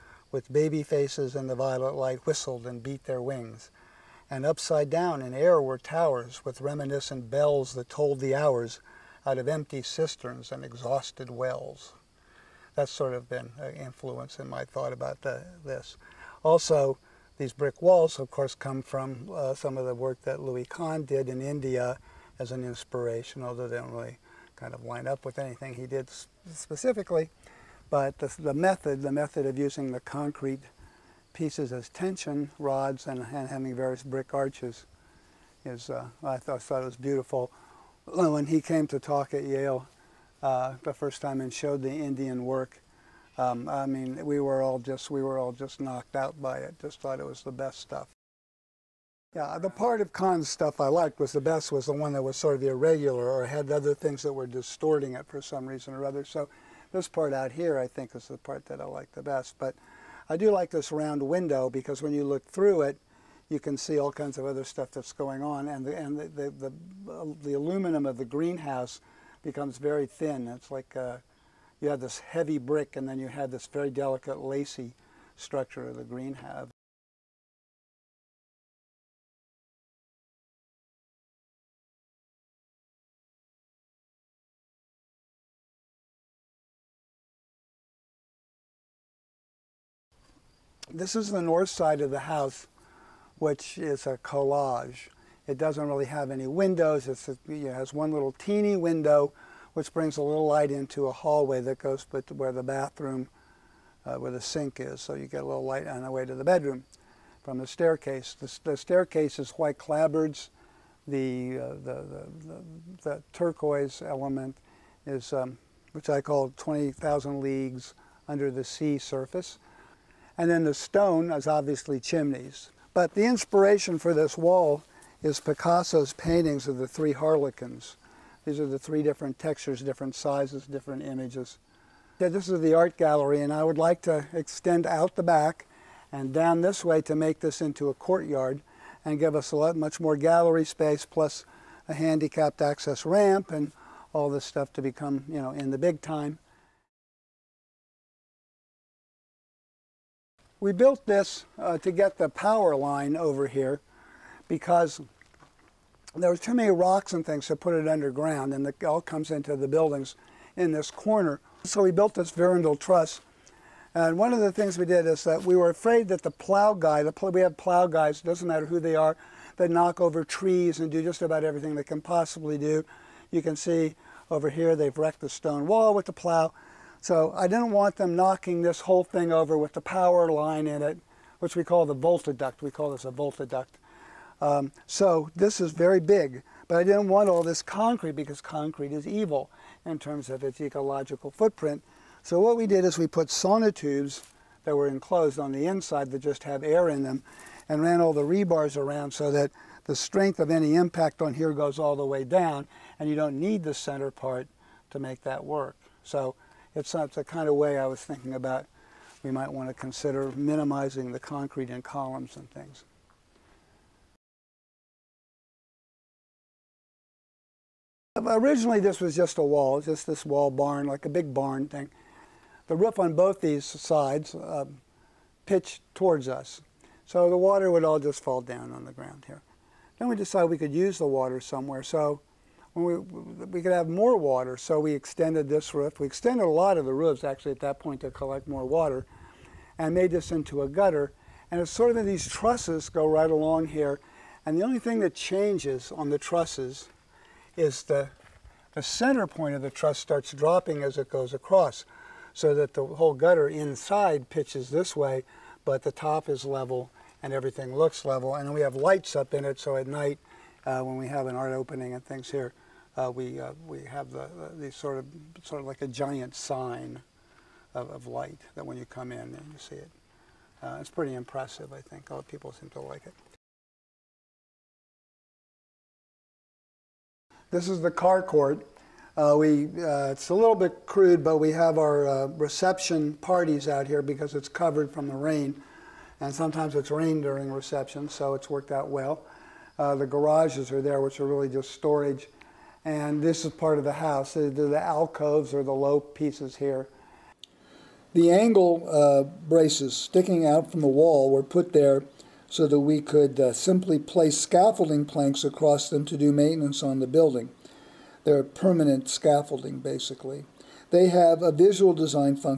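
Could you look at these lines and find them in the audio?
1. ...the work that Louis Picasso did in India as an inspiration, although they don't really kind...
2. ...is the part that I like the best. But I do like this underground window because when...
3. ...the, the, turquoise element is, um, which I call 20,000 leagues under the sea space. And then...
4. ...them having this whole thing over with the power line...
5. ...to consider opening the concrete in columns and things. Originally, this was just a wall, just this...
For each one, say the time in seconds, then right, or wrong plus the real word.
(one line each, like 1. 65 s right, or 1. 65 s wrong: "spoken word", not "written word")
1. 19 s wrong: "Kahn", not "Picasso"
2. 58 s wrong: "round", not "underground"
3. 112 s wrong: "surface", not "space"
4. 177 s wrong: "knocking", not "having"
5. 209 s wrong: "minimizing", not "opening".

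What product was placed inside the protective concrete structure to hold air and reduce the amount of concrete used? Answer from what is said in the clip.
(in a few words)
Sonotubes.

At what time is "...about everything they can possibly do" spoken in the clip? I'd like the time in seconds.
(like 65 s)
171 s.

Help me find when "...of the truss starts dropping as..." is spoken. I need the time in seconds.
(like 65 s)
249 s.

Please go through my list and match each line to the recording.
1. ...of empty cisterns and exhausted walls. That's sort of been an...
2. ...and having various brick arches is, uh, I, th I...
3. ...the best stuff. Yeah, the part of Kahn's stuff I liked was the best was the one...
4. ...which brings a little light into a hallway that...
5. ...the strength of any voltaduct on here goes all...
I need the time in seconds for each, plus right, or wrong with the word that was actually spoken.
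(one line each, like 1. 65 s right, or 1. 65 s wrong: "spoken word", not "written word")
1. 9 s wrong: "wells", not "walls"
2. 33 s right
3. 47 s right
4. 99 s right
5. 199 s wrong: "impact", not "voltaduct".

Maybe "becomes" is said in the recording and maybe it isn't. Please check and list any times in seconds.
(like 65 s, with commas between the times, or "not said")
69 s, 144 s.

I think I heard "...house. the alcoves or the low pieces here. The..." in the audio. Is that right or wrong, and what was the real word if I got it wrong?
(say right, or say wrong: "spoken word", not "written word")
right.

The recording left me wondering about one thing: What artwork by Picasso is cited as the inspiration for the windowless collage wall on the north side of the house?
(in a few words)
three harlequins.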